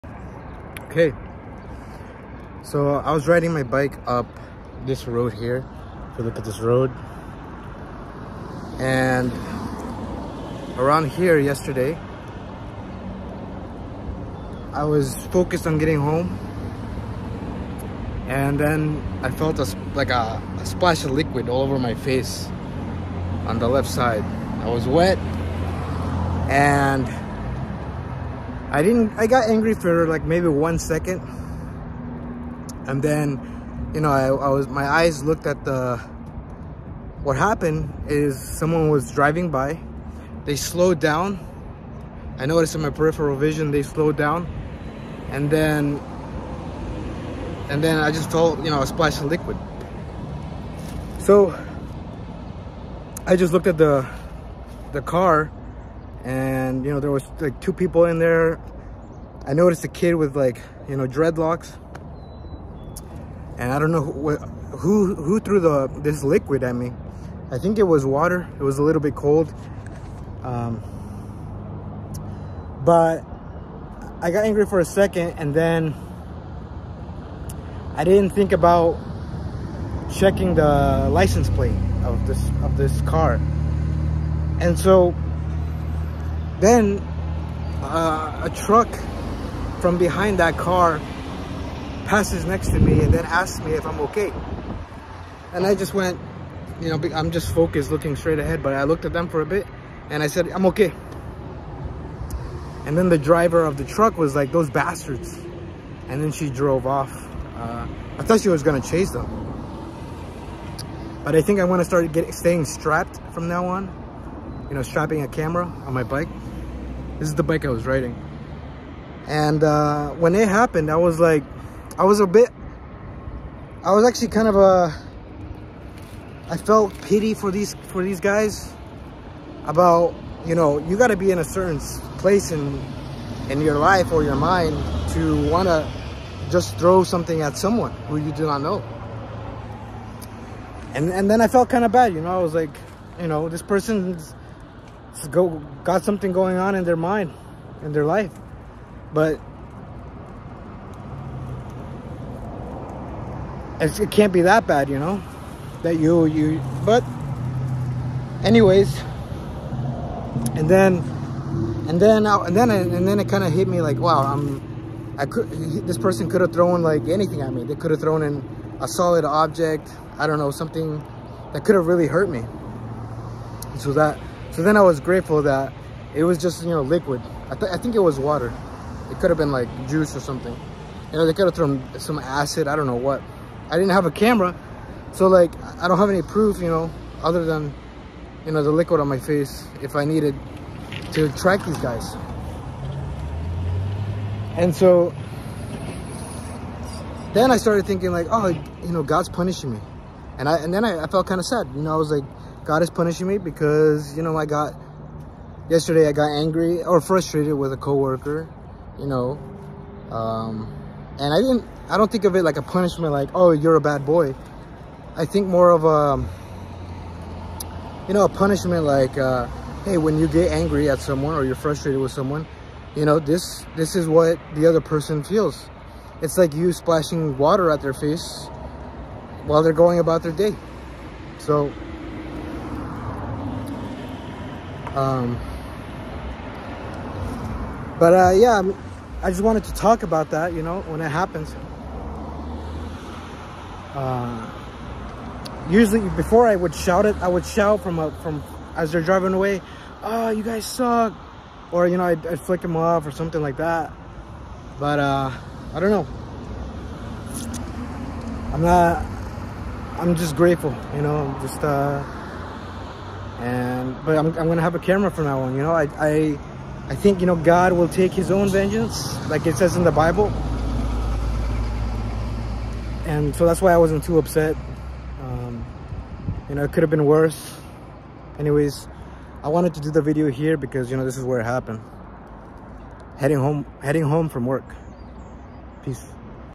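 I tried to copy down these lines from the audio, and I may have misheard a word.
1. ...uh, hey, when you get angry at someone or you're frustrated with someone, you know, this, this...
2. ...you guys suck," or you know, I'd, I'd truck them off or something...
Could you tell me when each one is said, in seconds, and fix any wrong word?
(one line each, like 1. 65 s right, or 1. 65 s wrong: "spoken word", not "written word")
1. 219 s right
2. 250 s wrong: "flick", not "truck".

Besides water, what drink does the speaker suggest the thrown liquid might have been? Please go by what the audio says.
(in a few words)
Juice.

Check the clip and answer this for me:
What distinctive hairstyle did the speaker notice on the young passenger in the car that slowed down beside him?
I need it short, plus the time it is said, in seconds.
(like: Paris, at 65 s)
Dreadlocks, at 61 s.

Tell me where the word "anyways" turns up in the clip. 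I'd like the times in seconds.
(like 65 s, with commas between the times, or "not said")
158 s, 278 s.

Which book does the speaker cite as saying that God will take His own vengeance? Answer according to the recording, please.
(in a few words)
The Bible.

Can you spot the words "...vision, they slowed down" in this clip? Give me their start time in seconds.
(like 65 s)
43 s.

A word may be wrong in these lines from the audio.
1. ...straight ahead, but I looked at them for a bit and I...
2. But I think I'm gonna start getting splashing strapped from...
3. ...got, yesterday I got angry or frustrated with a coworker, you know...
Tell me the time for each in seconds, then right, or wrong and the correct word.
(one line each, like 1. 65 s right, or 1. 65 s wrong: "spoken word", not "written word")
1. 98 s right
2. 111 s wrong: "staying", not "splashing"
3. 204 s right.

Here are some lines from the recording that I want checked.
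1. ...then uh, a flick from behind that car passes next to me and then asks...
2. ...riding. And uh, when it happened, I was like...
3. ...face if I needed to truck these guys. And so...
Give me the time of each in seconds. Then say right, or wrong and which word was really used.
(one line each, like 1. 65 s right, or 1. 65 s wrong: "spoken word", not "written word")
1. 86 s wrong: "truck", not "flick"
2. 117 s right
3. 189 s wrong: "track", not "truck".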